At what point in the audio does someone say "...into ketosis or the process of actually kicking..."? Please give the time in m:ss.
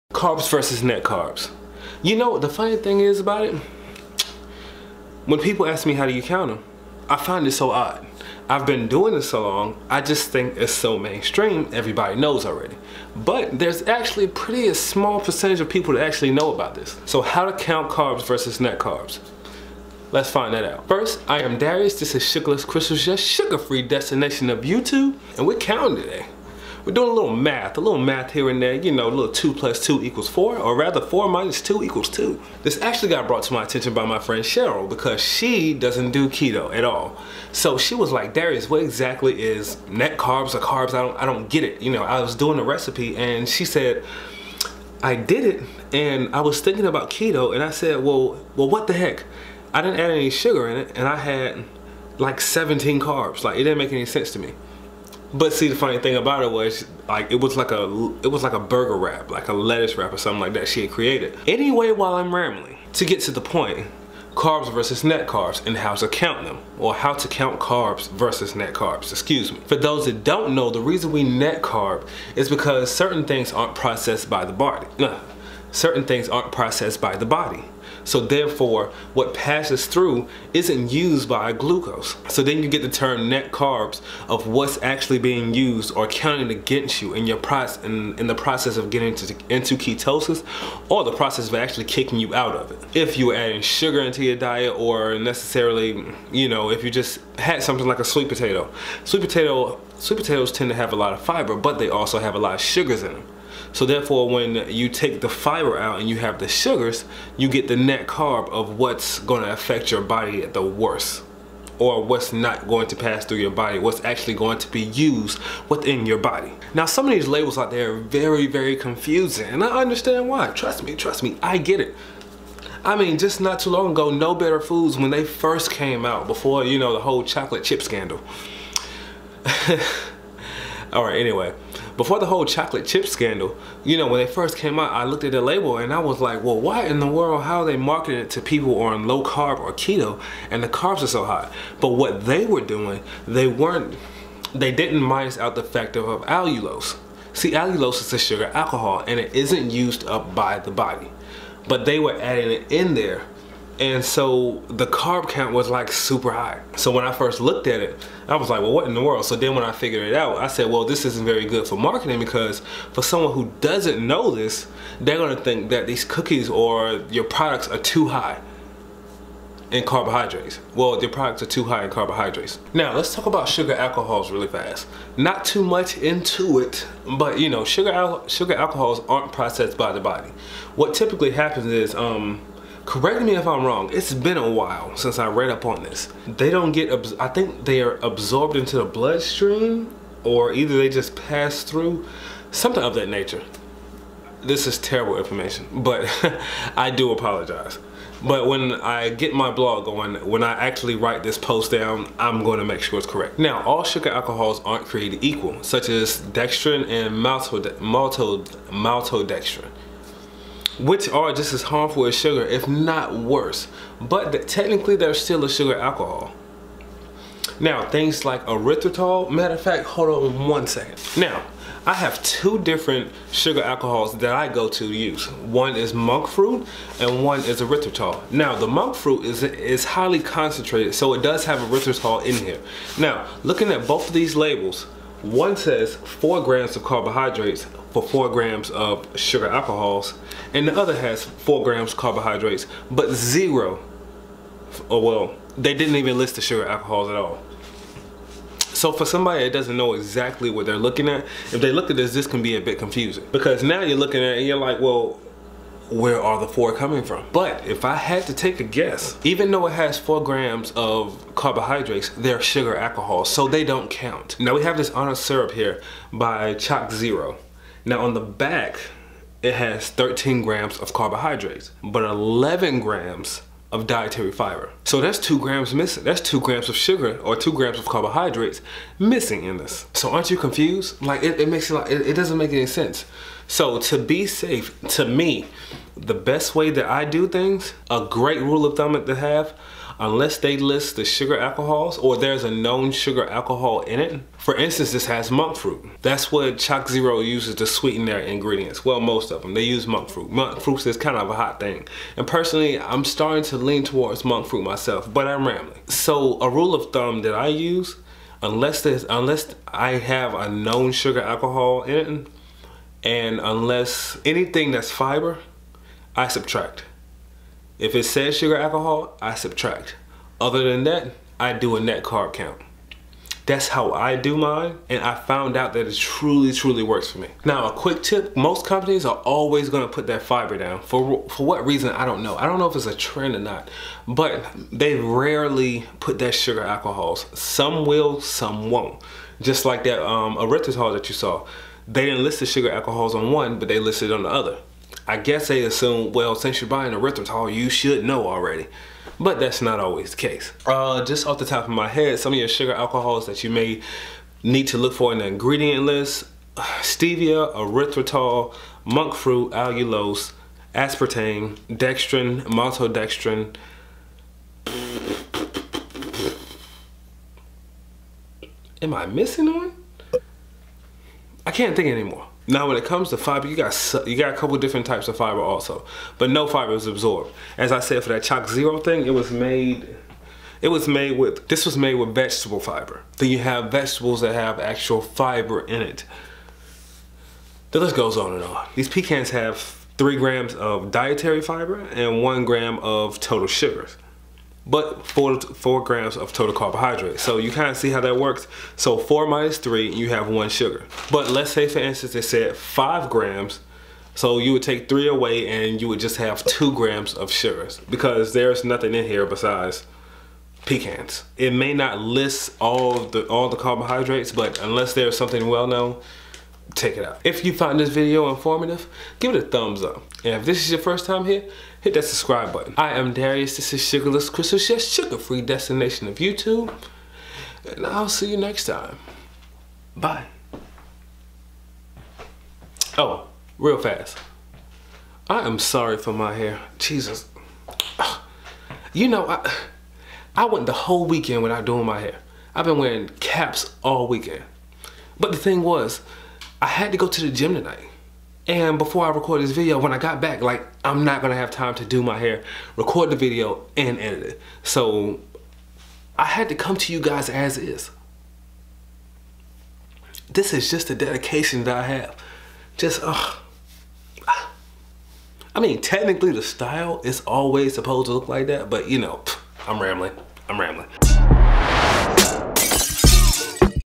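1:29.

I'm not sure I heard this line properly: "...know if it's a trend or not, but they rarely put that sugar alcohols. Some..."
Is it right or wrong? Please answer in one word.
right.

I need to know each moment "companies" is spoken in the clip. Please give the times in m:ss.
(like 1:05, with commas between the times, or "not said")
5:28.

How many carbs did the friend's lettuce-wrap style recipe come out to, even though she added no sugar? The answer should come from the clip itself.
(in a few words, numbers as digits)
17.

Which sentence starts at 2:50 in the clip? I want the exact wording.
Well, your products are too high in carbohydrates.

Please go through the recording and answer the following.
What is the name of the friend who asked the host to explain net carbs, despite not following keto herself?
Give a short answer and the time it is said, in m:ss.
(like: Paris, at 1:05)
Cheryl, at 0:34.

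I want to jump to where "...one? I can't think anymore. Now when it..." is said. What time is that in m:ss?
6:09.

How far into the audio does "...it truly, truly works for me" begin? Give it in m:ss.
5:25.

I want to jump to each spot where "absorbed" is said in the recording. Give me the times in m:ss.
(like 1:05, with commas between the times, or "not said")
3:07, 6:16.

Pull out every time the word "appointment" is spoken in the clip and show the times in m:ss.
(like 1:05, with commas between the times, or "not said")
not said.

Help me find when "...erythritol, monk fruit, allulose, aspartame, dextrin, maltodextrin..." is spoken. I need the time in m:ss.
5:57.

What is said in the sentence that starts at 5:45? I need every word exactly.
I guess they assume, well, since you're buying a erythritol, you should know already.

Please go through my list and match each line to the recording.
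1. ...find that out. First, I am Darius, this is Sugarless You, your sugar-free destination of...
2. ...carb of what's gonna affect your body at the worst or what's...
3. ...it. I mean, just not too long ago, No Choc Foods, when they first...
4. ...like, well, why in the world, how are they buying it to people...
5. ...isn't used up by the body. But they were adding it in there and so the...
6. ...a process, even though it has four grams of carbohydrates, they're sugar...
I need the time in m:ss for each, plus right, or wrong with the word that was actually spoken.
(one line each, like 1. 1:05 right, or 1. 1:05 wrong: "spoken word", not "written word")
1. 0:20 wrong: "Crystals", not "You"
2. 1:48 right
3. 2:01 wrong: "Better", not "Choc"
4. 2:16 wrong: "marketing", not "buying"
5. 2:29 right
6. 4:18 wrong: "guess", not "process".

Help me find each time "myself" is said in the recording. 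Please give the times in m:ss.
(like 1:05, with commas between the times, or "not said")
5:04.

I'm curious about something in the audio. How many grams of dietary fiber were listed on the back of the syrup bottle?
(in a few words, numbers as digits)
11 grams.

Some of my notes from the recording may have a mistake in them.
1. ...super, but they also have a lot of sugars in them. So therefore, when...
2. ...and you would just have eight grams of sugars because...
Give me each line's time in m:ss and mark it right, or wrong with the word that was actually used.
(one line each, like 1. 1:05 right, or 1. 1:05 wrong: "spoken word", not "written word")
1. 1:41 wrong: "fiber", not "super"
2. 6:45 wrong: "two", not "eight".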